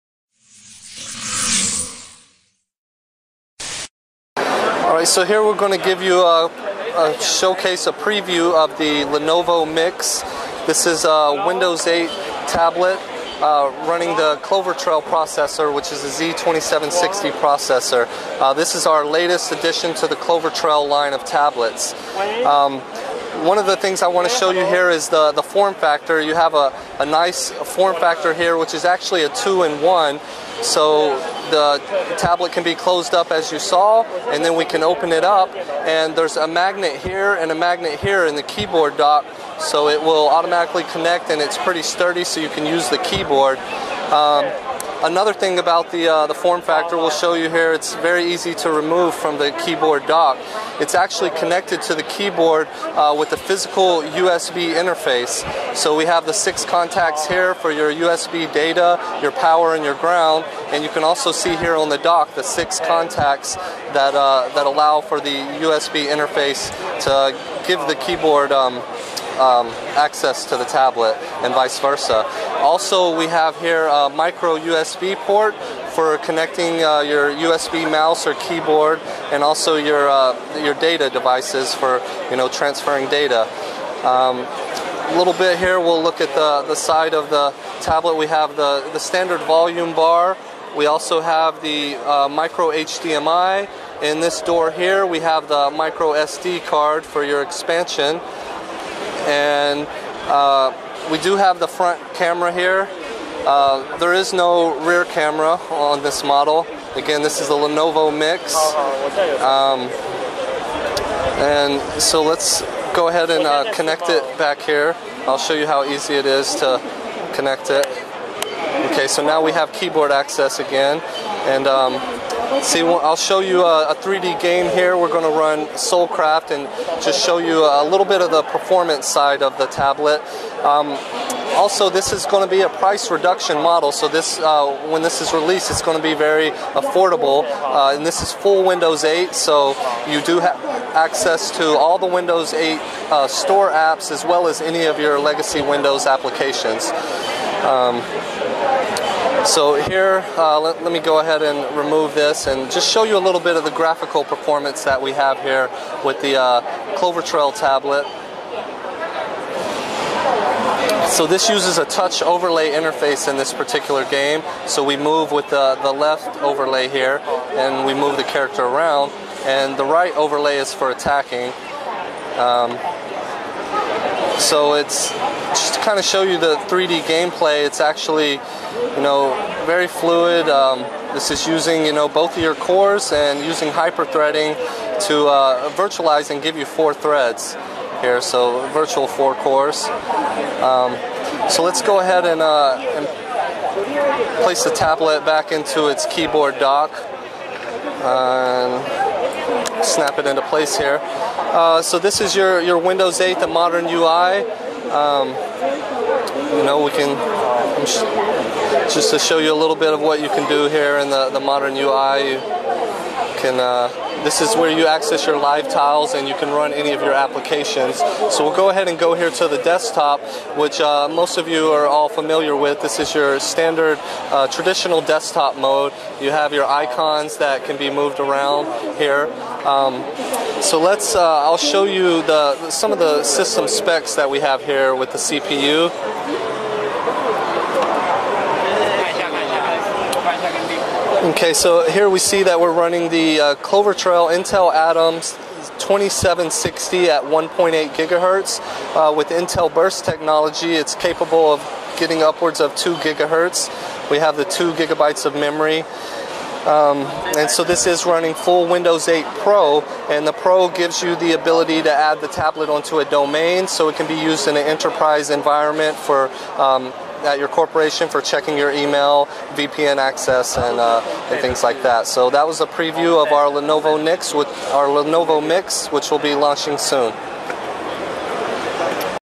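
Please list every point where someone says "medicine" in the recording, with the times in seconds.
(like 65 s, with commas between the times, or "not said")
not said.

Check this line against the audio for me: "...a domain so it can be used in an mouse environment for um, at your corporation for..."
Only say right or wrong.
wrong.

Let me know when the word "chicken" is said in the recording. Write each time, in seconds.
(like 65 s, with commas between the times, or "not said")
not said.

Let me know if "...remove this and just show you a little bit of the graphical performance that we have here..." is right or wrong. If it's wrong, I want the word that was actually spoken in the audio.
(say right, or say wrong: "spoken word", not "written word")
right.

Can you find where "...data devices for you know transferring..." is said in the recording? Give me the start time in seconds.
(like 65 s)
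80 s.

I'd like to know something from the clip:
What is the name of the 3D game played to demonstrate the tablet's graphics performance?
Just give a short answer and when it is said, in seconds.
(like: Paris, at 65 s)
Soulcraft, at 125 s.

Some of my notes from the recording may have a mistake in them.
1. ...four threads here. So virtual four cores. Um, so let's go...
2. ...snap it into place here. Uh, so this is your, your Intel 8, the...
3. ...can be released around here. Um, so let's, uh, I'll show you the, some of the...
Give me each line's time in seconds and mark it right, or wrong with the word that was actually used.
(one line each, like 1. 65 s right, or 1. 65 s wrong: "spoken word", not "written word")
1. 186 s right
2. 199 s wrong: "Windows", not "Intel"
3. 227 s wrong: "moved", not "released".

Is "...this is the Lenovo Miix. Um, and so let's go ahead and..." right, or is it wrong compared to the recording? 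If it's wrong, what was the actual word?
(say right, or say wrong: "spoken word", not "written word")
right.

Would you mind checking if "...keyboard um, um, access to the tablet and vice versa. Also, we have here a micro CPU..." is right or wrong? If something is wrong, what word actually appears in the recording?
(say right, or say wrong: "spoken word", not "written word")
wrong: "USB", not "CPU".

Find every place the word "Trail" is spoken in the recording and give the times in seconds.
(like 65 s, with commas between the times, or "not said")
14 s, 20 s, 157 s, 243 s.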